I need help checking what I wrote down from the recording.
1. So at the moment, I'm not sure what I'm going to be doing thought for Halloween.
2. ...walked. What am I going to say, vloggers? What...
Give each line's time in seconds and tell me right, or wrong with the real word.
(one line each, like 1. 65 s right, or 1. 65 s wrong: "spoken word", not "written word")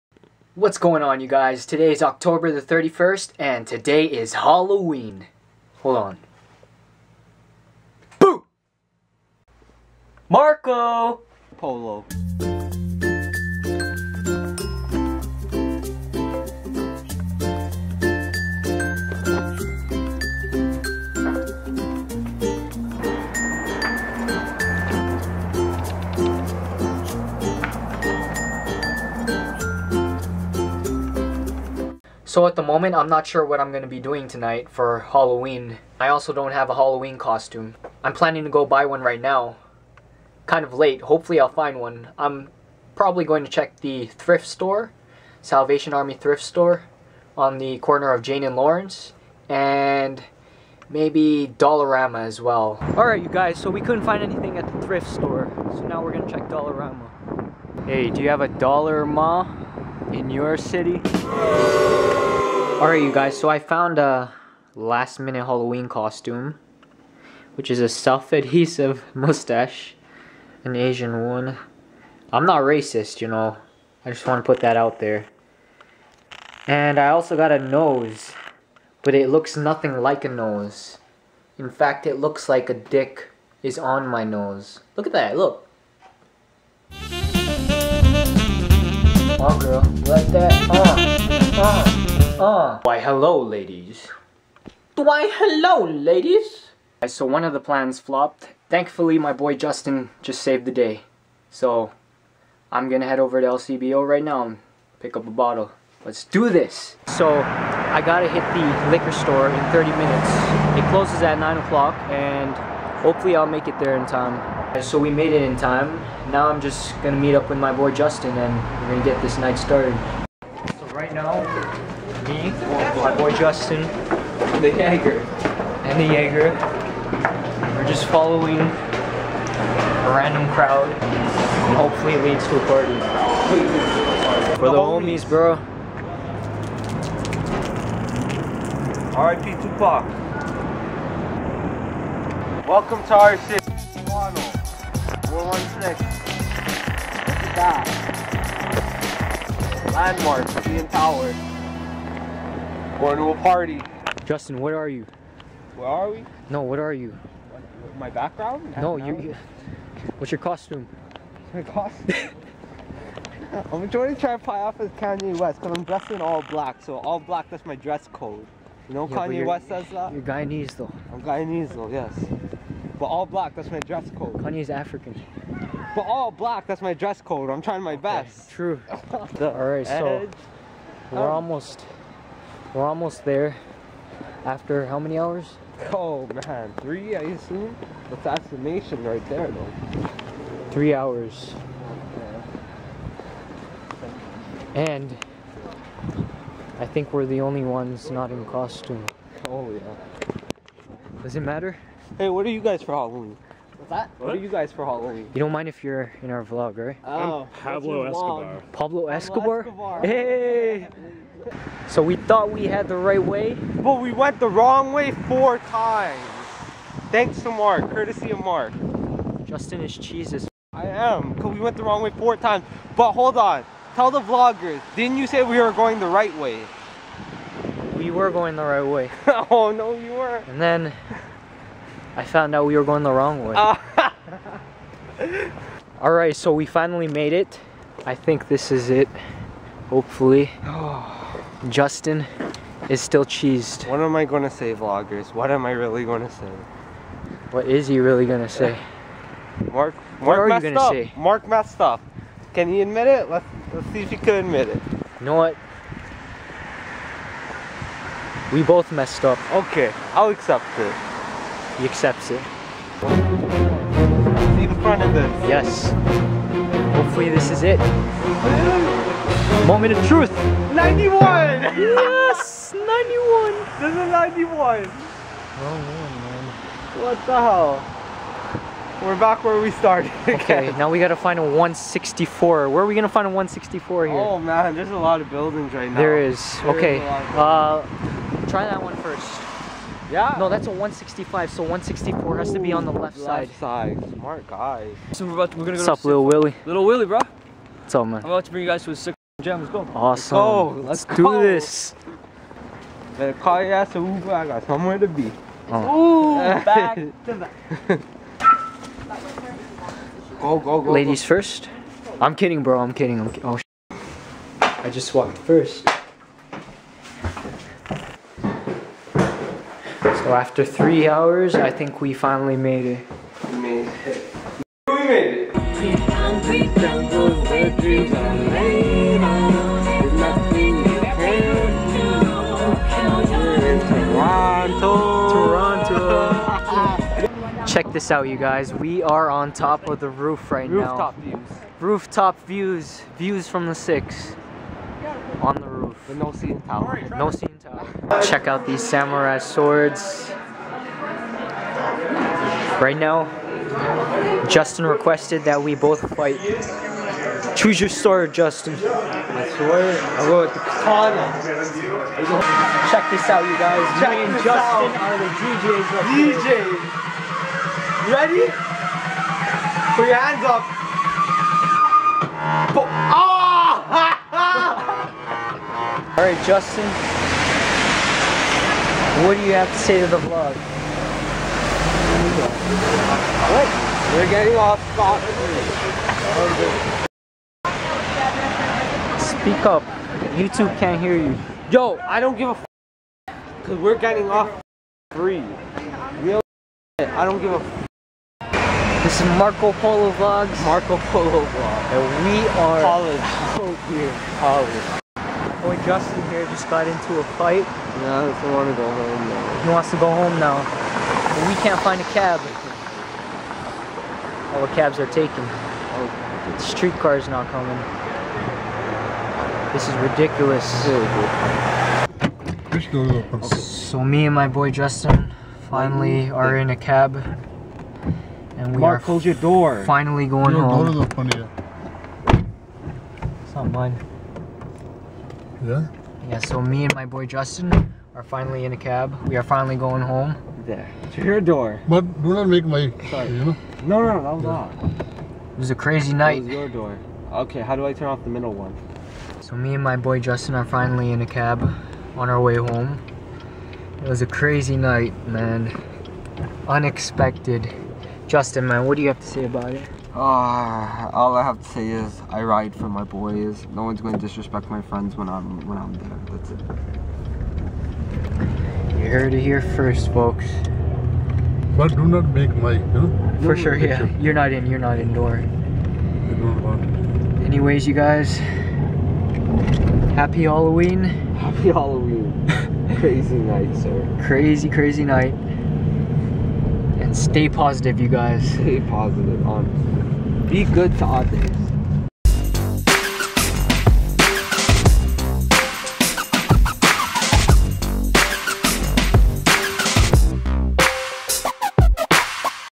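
1. 32 s wrong: "tonight", not "thought"
2. 243 s wrong: "cheesed", not "walked".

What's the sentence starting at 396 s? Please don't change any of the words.
Real I don't give a f this is Marco Polo Vlogs.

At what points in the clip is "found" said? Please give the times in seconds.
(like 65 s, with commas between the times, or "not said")
63 s, 232 s.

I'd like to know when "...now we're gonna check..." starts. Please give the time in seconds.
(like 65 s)
55 s.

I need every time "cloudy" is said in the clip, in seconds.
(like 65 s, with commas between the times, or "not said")
not said.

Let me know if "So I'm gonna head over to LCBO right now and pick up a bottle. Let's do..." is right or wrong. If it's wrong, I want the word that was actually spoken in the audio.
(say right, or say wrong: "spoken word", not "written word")
right.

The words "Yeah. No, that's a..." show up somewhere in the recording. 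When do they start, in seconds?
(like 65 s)
290 s.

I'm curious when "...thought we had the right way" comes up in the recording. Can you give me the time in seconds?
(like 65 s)
212 s.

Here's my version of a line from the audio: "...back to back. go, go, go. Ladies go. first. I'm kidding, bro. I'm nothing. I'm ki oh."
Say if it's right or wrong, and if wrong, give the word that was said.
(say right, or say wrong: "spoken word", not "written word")
wrong: "kidding", not "nothing".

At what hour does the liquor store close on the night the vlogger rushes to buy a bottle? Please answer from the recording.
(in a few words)
9 o'clock.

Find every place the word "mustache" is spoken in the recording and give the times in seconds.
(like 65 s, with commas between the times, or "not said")
69 s.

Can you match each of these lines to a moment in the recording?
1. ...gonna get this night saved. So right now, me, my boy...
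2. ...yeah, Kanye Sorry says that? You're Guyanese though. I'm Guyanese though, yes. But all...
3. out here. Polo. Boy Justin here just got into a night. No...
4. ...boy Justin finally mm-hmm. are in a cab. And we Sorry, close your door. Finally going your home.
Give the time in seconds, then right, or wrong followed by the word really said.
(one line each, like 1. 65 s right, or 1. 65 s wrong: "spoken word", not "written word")
1. 118 s wrong: "started", not "saved"
2. 169 s wrong: "West", not "Sorry"
3. 403 s wrong: "fight", not "night"
4. 424 s wrong: "Mark", not "Sorry".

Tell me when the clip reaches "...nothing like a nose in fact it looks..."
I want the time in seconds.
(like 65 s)
79 s.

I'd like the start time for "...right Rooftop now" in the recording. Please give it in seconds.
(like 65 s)
340 s.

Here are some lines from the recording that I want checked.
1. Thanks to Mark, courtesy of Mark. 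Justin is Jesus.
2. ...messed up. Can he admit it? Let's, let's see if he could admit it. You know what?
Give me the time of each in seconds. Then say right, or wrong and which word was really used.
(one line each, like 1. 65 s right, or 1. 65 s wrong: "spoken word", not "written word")
1. 217 s right
2. 251 s right.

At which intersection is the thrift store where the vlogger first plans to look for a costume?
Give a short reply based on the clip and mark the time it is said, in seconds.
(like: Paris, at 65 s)
Jane and Lawrence, at 48 s.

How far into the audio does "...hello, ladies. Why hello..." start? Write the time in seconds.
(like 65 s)
92 s.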